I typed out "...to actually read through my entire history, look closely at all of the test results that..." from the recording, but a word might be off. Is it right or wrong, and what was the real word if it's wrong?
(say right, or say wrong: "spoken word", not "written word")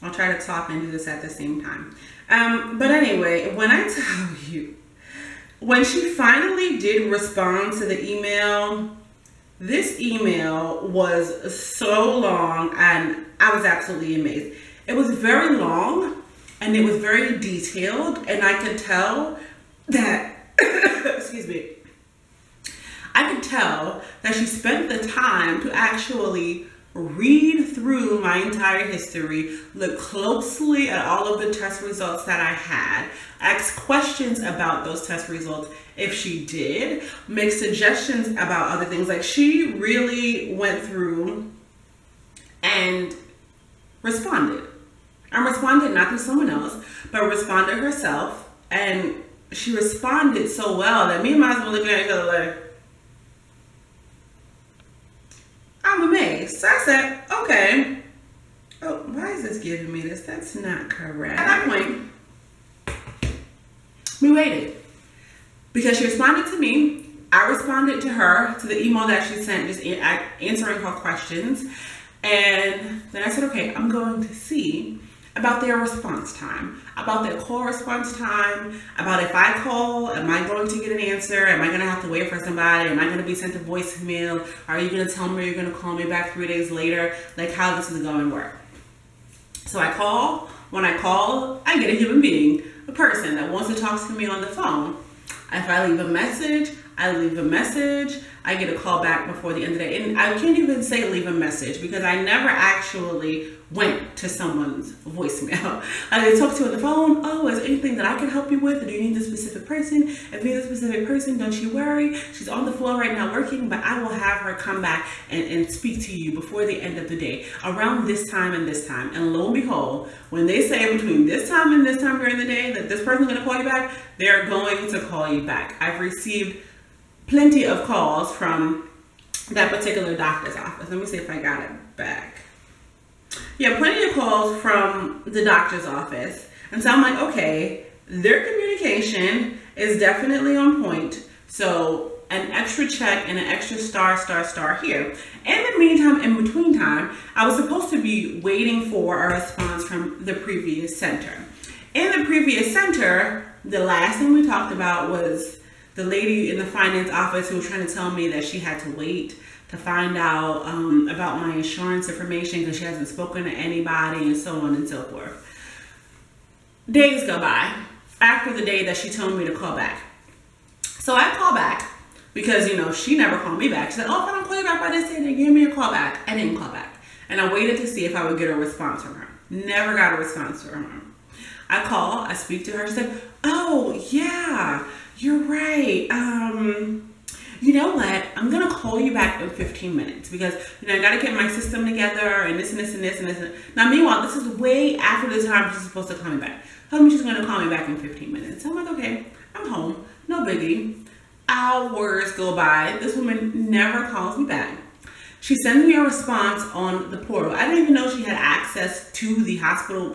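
right.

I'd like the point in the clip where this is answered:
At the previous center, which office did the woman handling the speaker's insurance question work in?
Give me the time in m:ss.
2:36.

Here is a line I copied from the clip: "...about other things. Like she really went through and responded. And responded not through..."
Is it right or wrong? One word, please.
right.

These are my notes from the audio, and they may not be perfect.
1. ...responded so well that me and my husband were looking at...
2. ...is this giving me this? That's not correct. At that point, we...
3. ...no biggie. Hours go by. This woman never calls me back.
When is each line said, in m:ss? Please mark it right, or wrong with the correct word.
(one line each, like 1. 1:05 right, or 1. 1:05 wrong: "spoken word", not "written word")
1. 0:49 right
2. 0:59 right
3. 3:20 right.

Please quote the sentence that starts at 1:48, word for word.
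do you need a specific person?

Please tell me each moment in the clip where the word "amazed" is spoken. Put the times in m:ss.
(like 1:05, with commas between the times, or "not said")
0:14, 0:56.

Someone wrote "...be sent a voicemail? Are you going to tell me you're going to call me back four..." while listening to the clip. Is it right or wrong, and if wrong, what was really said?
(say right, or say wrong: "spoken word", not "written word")
wrong: "three", not "four".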